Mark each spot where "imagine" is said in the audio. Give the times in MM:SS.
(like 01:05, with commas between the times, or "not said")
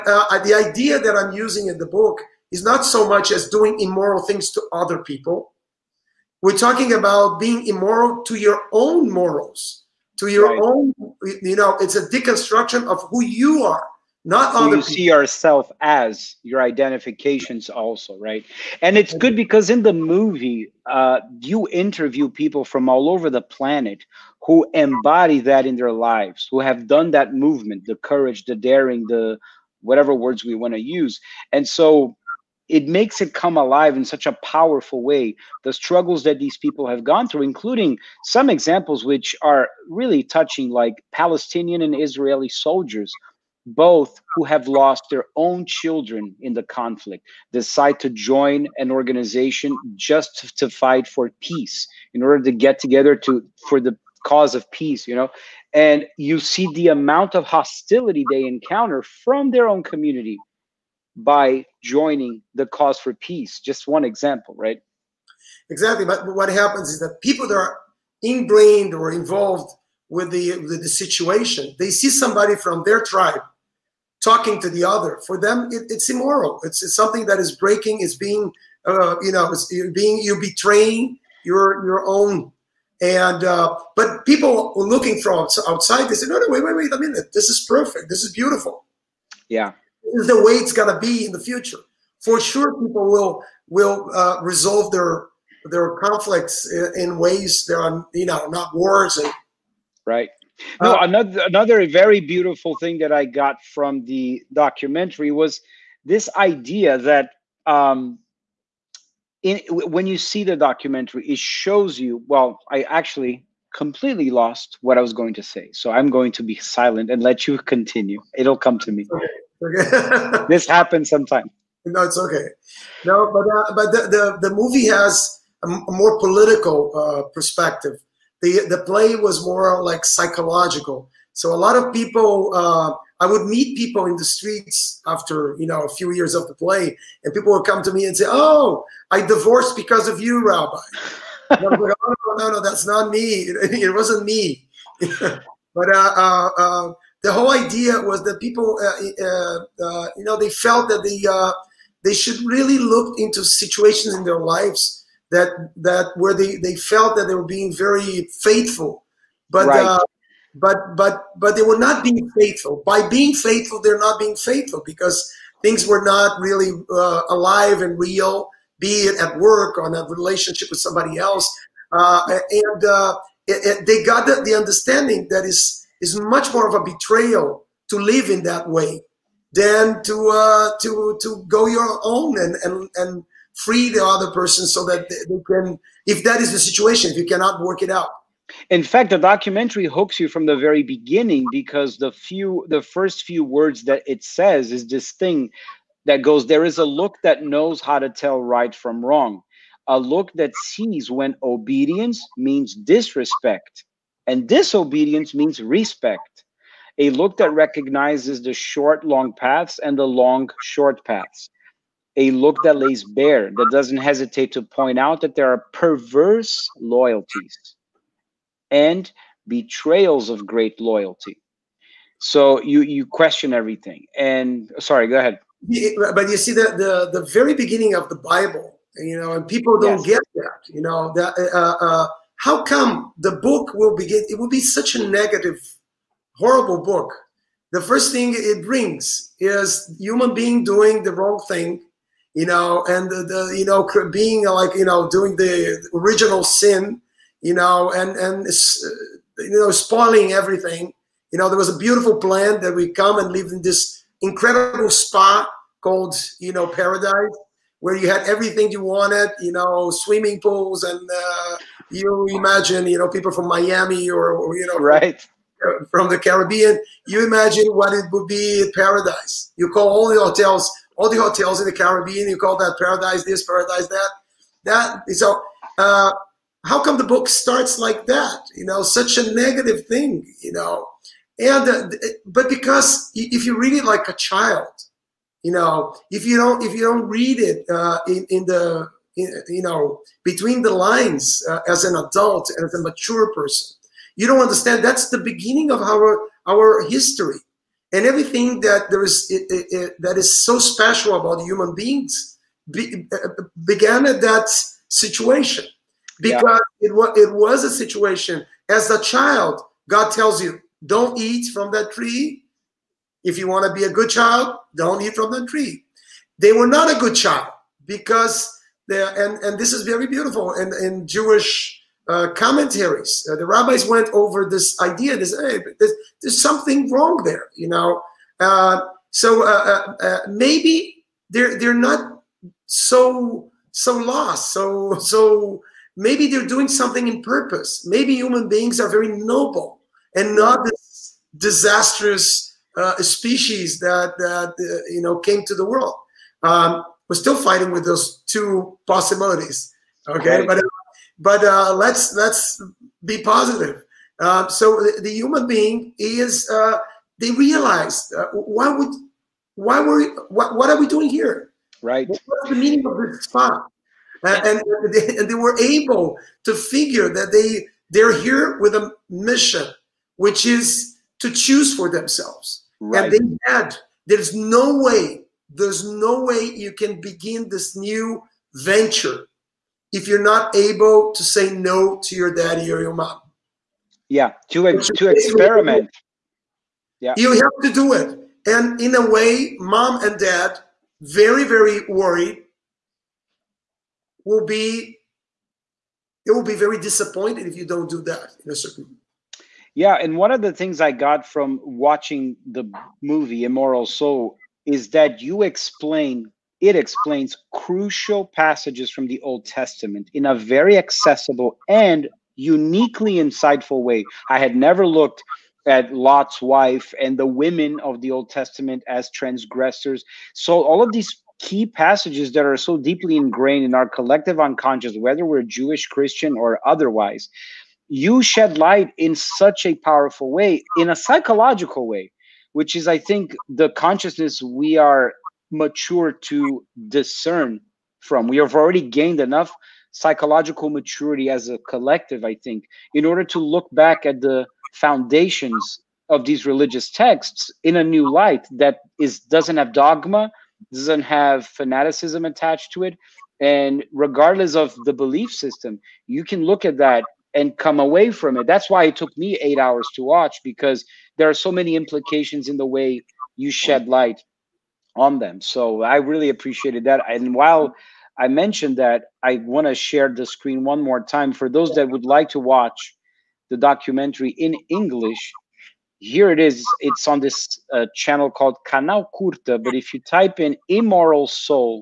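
04:22, 04:27.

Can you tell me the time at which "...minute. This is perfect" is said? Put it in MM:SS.
01:26.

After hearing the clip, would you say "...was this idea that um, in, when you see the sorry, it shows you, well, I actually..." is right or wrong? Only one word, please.
wrong.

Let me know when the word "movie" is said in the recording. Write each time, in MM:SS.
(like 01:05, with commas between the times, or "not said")
00:19, 02:04, 06:43.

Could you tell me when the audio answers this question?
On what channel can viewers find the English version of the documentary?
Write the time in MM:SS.
07:58.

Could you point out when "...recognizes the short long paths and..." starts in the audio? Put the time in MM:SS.
03:27.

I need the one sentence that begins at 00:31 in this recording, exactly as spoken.
And so it makes it come alive in such a powerful way.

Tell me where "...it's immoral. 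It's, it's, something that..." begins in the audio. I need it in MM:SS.
01:15.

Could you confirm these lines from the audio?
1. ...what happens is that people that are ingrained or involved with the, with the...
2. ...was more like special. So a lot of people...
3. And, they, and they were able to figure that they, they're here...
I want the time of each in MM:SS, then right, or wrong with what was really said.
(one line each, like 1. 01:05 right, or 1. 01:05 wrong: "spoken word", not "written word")
1. 01:06 right
2. 02:09 wrong: "psychological", not "special"
3. 06:04 right.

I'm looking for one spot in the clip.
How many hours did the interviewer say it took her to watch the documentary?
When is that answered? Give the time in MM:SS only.
07:39.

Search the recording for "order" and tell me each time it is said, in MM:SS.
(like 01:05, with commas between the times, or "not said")
00:52, 07:23.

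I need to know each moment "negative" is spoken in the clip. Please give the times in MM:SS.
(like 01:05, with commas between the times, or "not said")
03:55, 04:39.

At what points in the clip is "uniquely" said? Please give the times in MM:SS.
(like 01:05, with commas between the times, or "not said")
06:52.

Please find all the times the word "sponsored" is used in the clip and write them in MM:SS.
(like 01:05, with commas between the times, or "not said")
not said.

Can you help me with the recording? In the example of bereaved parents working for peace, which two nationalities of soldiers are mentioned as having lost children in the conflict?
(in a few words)
Palestinian and Israeli.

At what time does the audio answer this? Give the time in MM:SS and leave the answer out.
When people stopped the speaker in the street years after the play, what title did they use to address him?
02:20.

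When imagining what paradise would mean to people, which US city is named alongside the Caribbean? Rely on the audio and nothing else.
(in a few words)
Miami.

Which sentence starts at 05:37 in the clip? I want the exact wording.
Maybe human beings are very noble and not this disastrous uh, species that, that uh, you know came to the world.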